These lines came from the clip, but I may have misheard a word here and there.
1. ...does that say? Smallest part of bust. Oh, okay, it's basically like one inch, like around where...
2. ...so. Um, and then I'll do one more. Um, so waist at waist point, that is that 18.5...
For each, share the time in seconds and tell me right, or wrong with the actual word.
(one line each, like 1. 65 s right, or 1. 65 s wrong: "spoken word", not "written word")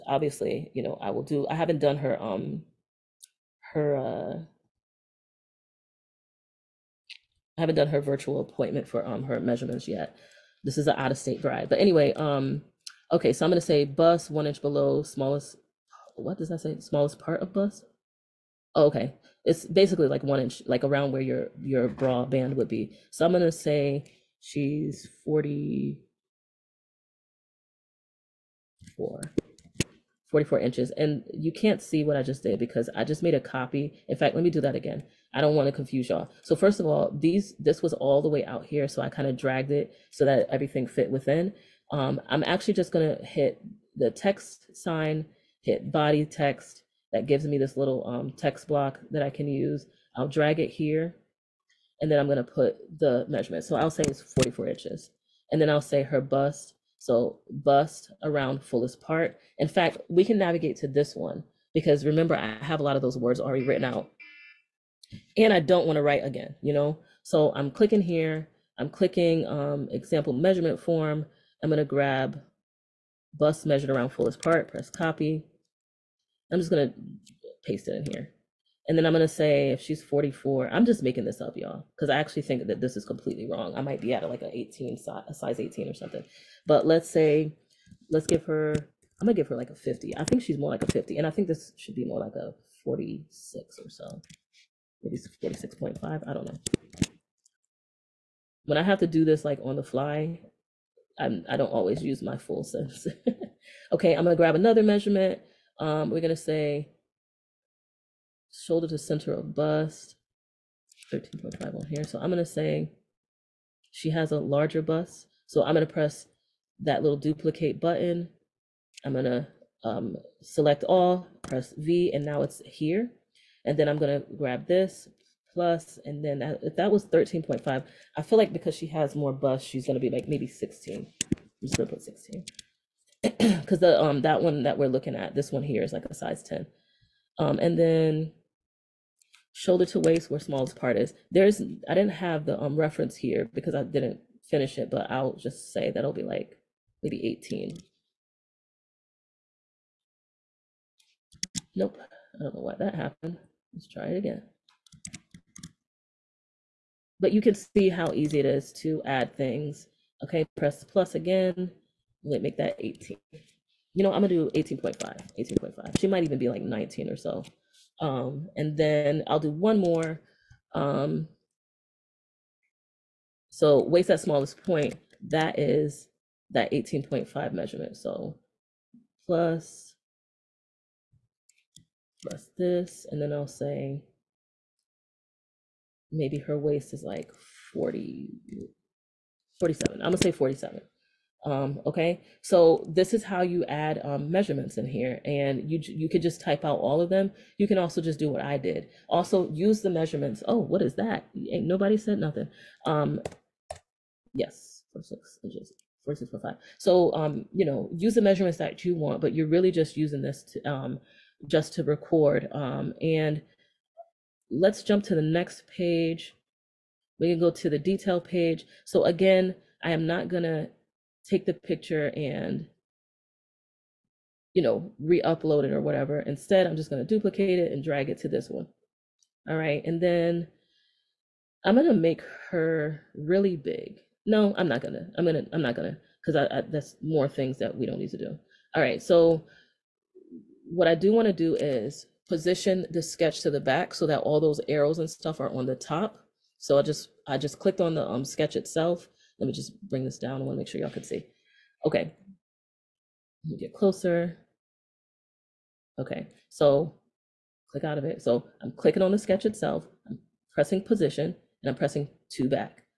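1. 16 s right
2. 167 s wrong: "smallest", not "waist".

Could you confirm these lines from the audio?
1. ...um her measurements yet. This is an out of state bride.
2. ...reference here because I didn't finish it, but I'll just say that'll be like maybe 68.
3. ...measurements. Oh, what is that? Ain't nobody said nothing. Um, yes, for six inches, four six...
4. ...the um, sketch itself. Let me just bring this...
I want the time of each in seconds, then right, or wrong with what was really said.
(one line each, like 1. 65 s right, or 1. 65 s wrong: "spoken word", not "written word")
1. 9 s right
2. 142 s wrong: "18", not "68"
3. 199 s right
4. 247 s right.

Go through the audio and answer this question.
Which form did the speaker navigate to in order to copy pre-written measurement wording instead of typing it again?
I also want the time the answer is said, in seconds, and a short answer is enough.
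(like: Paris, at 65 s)
Example measurement form, at 69 s.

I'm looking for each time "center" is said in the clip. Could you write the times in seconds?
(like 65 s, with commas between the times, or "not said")
108 s.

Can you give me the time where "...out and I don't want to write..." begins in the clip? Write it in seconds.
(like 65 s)
63 s.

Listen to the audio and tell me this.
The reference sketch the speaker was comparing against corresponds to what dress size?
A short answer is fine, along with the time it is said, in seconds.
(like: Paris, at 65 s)
Size 10, at 136 s.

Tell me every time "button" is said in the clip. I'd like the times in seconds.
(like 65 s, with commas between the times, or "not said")
117 s.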